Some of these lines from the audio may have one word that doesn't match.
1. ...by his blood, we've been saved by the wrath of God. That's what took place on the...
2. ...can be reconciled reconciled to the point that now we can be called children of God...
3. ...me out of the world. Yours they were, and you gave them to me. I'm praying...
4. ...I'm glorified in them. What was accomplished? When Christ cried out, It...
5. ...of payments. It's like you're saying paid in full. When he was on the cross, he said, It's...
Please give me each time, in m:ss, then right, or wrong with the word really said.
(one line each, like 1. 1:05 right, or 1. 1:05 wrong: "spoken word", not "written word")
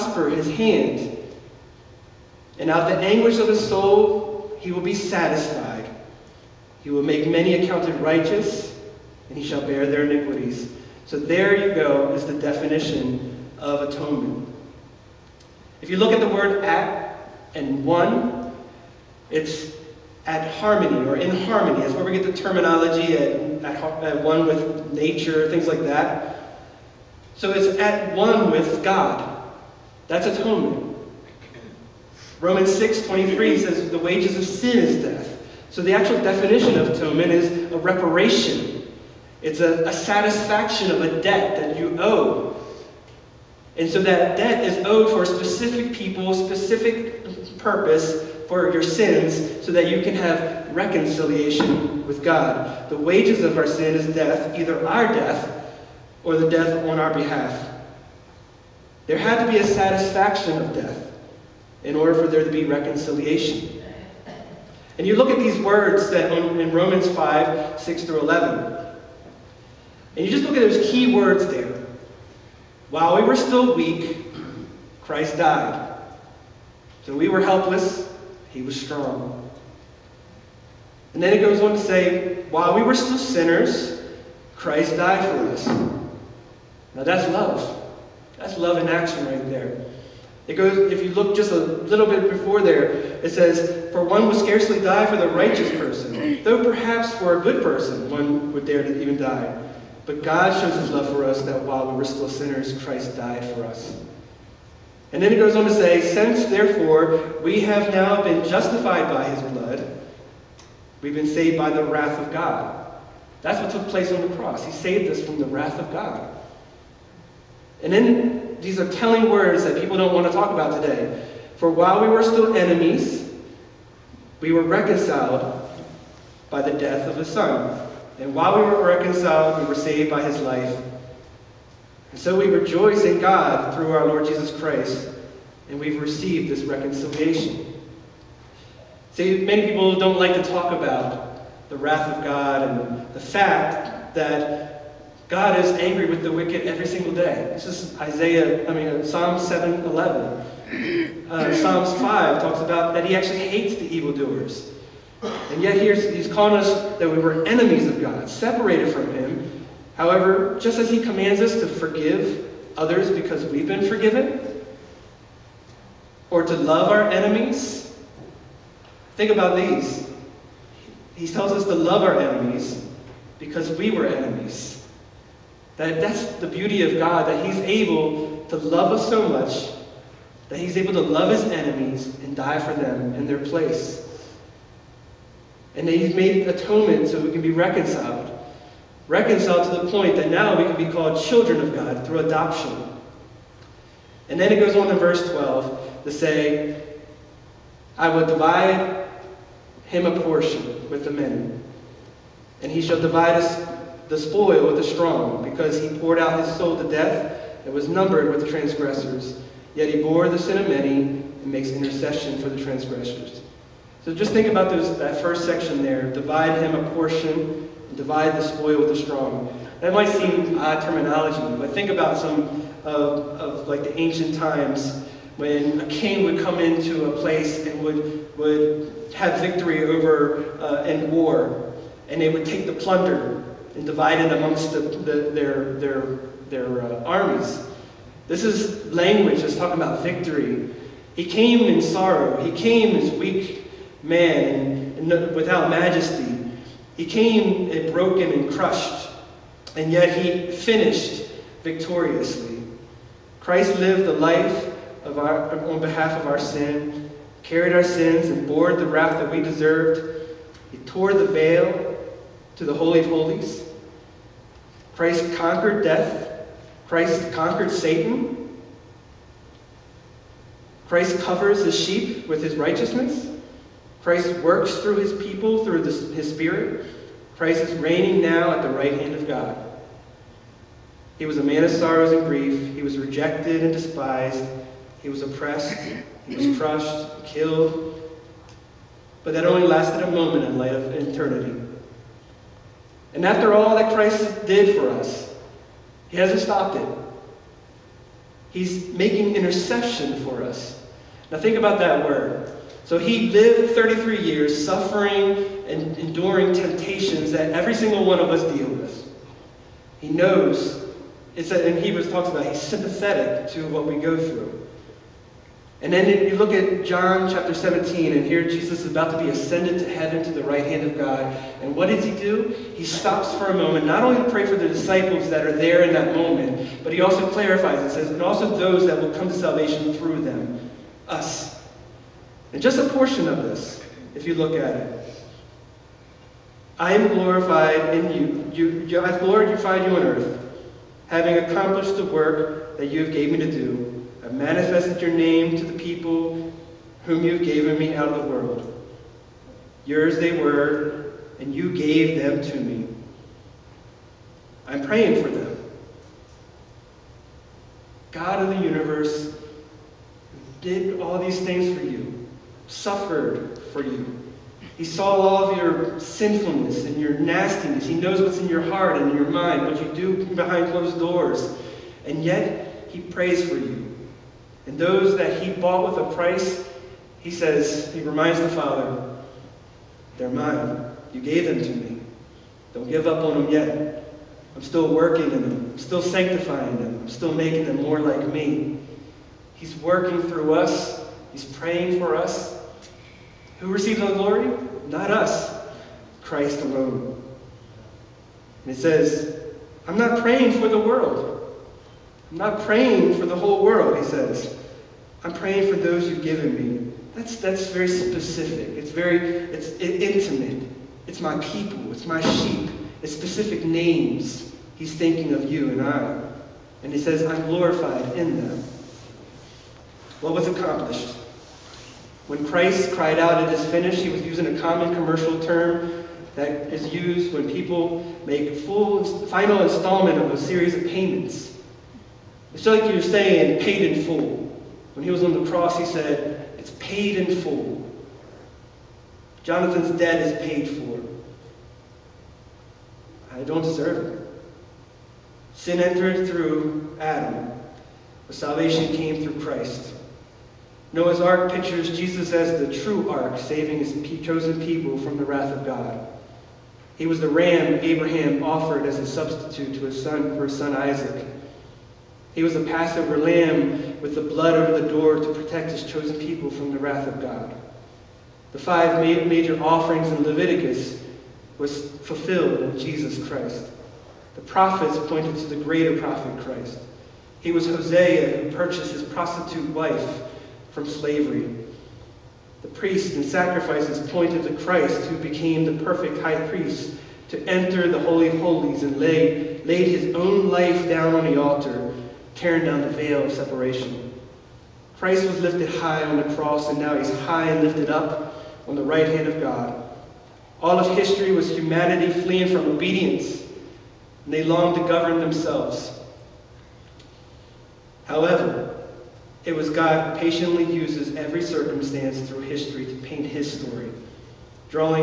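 1. 1:49 right
2. 3:07 right
3. 5:47 right
4. 6:57 right
5. 7:10 right.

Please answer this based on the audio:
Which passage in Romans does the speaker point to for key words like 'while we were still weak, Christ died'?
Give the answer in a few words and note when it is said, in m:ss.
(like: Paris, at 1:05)
Romans 5:6-11, at 1:06.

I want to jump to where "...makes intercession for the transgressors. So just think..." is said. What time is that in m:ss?
3:31.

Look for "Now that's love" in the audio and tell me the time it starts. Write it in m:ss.
1:26.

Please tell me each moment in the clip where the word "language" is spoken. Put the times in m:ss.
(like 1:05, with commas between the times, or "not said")
3:58.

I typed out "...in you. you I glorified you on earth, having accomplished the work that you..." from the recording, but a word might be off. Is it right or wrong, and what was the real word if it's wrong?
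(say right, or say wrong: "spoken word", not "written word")
right.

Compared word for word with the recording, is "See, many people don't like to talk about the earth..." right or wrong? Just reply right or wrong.
wrong.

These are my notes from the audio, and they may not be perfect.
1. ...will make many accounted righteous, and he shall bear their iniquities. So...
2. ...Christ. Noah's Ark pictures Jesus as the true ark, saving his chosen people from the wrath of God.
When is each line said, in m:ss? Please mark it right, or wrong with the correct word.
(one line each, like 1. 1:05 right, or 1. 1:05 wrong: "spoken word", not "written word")
1. 0:06 right
2. 7:29 right.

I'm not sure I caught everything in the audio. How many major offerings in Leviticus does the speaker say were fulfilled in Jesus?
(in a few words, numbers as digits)
5.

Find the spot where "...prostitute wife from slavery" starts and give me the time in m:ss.
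7:59.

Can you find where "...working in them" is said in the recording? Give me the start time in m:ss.
6:24.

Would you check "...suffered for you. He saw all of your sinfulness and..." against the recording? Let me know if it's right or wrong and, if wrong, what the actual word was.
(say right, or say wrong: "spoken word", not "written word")
right.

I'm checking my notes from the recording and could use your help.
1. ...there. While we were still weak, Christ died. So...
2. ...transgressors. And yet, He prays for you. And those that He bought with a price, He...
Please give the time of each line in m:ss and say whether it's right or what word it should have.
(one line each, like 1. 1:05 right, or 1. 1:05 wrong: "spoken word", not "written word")
1. 1:11 right
2. 6:10 wrong: "doors", not "transgressors".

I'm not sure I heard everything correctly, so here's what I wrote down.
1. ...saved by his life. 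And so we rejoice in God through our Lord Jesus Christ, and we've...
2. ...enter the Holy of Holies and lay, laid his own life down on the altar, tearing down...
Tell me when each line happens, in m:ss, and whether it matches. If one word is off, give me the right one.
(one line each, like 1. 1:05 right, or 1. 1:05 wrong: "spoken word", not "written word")
1. 2:09 right
2. 8:07 right.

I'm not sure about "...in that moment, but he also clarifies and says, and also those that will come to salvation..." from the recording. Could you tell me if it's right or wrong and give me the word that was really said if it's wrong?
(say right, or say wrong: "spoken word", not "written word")
right.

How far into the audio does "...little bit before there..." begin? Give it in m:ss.
1:31.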